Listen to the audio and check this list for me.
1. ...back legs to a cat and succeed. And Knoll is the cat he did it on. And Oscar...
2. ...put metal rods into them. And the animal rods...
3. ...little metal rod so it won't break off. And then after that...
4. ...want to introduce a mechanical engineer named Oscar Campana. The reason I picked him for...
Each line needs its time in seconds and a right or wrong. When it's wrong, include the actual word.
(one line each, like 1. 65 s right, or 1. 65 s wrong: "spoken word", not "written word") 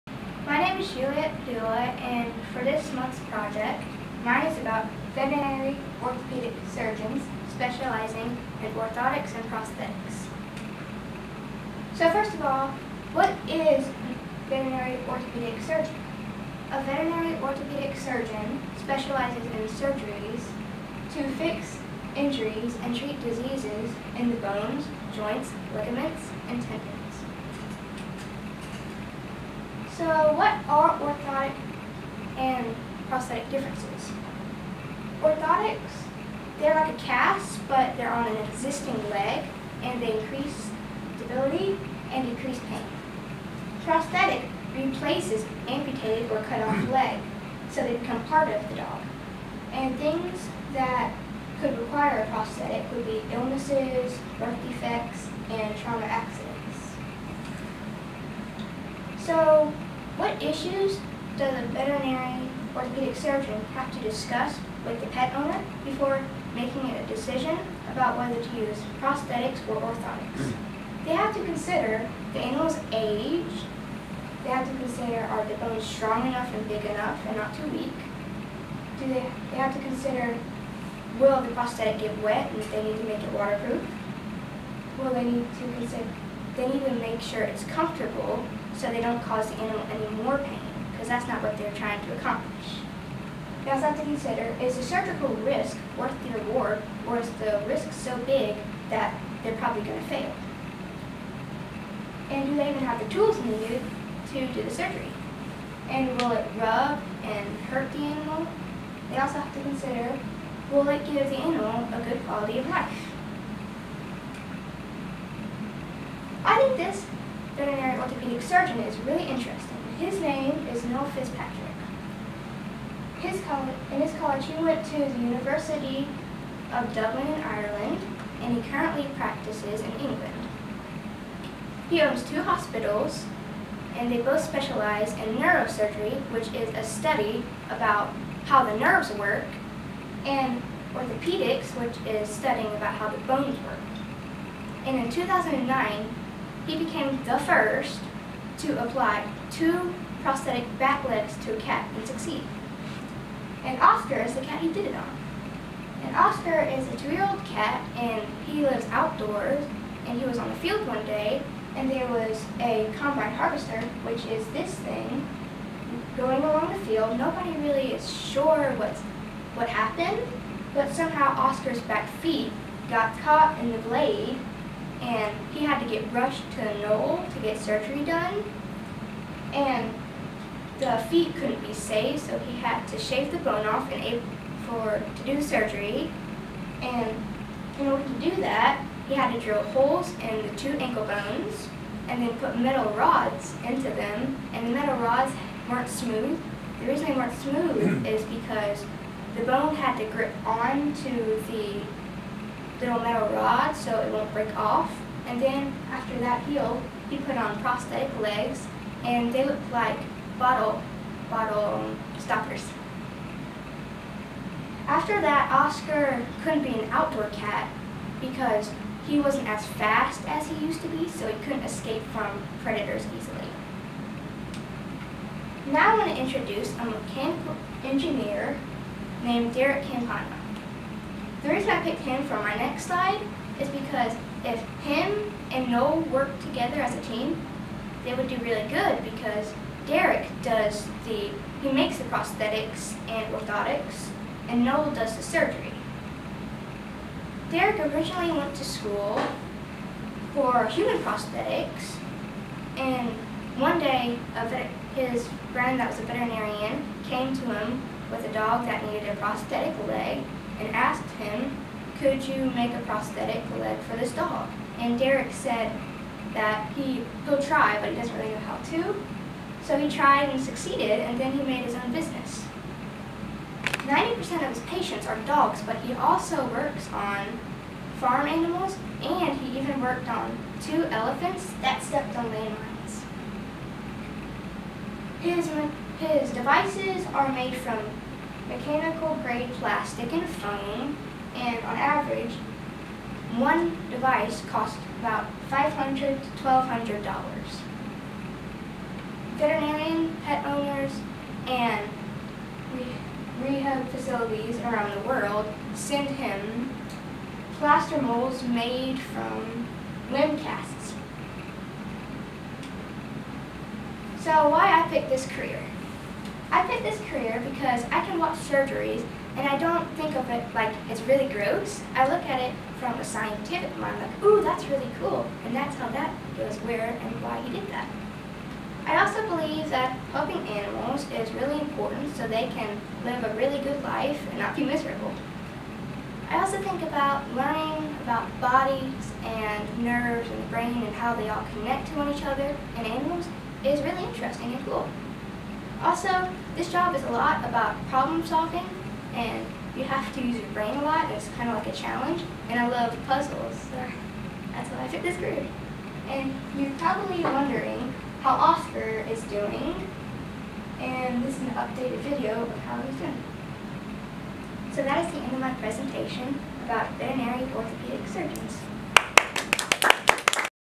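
1. 150 s wrong: "Oscar", not "Knoll"
2. 192 s wrong: "metal", not "animal"
3. 202 s right
4. 225 s wrong: "Derek", not "Oscar".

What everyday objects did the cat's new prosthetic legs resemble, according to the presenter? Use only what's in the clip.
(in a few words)
bottle stoppers.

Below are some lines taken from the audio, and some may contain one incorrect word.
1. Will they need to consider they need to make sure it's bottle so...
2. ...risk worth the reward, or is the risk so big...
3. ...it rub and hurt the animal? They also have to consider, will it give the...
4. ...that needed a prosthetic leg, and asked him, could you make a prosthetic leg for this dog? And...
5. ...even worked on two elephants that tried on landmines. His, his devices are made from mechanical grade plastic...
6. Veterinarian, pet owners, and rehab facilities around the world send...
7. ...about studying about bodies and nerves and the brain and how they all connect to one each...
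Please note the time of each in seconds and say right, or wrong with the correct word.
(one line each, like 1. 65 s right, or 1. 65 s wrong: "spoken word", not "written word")
1. 85 s wrong: "comfortable", not "bottle"
2. 95 s right
3. 106 s right
4. 258 s right
5. 279 s wrong: "stepped", not "tried"
6. 299 s right
7. 336 s wrong: "learning", not "studying".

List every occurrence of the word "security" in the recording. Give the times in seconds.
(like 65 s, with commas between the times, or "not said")
not said.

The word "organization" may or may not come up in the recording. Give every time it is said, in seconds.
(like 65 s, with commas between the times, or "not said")
not said.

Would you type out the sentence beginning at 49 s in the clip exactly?
And things that could require a prosthetic would be illnesses, birth defects, and trauma accidents.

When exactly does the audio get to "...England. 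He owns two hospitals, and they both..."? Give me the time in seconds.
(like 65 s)
129 s.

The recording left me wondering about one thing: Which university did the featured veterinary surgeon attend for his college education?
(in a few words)
University of Dublin.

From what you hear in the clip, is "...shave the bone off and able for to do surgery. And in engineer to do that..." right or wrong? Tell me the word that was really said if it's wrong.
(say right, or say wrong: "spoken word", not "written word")
wrong: "order", not "engineer".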